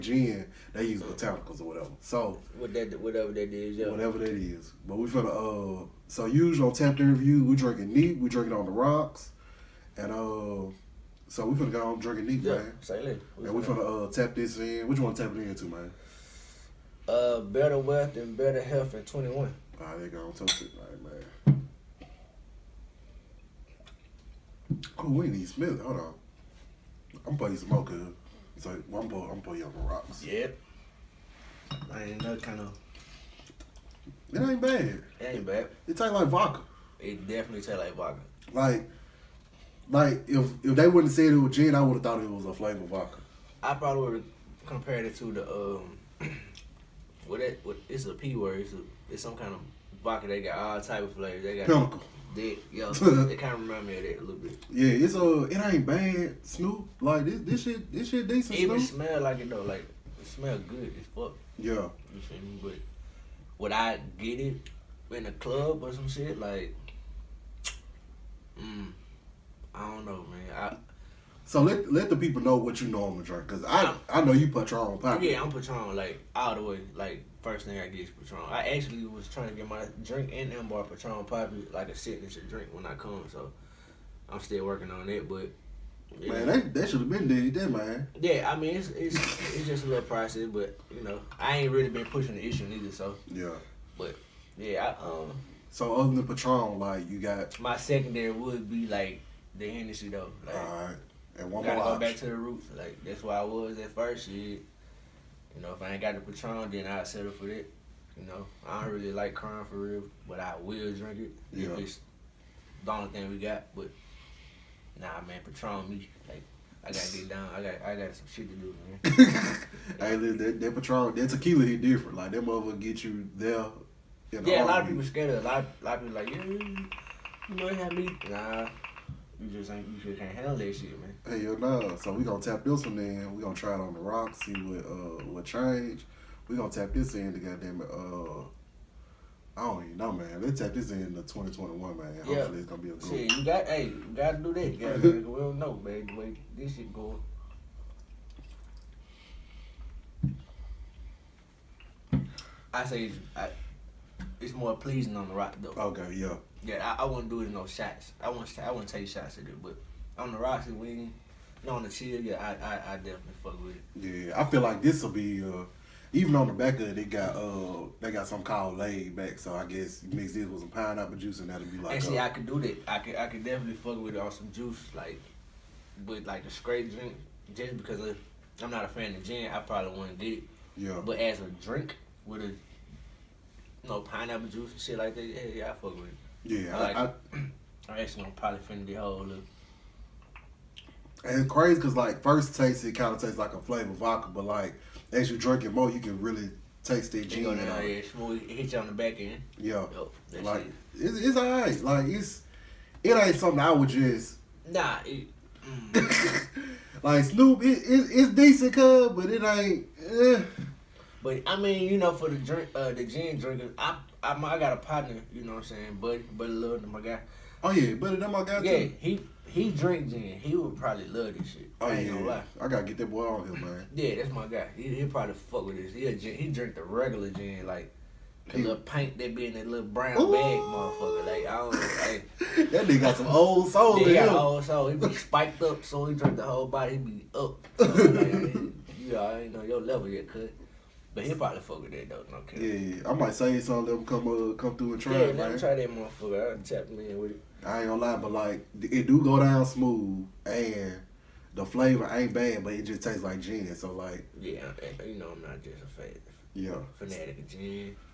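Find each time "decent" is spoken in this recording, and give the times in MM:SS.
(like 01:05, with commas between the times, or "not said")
00:58, 03:28.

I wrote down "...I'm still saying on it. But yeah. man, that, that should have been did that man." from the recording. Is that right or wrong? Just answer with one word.
wrong.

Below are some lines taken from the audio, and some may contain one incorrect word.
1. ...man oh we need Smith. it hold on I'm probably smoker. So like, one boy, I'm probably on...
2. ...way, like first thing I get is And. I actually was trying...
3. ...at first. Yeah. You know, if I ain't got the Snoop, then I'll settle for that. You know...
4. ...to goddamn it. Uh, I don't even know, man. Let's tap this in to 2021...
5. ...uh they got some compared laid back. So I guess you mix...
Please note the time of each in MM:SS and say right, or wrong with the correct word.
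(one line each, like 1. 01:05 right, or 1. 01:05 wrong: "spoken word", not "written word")
1. 00:21 right
2. 01:16 wrong: "Patron", not "And"
3. 01:43 wrong: "Patron", not "Snoop"
4. 02:17 right
5. 02:47 wrong: "called", not "compared".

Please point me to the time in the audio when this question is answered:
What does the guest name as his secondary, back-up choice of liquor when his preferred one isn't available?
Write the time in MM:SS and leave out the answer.
01:39.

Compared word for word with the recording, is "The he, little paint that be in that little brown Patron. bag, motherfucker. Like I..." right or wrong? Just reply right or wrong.
wrong.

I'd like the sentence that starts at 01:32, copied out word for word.
So yeah, but yeah, I, um.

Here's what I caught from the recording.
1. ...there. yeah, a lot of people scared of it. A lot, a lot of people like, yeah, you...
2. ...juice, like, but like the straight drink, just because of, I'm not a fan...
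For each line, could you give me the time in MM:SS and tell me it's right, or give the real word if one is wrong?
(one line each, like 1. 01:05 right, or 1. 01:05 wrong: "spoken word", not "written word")
1. 02:03 right
2. 02:54 right.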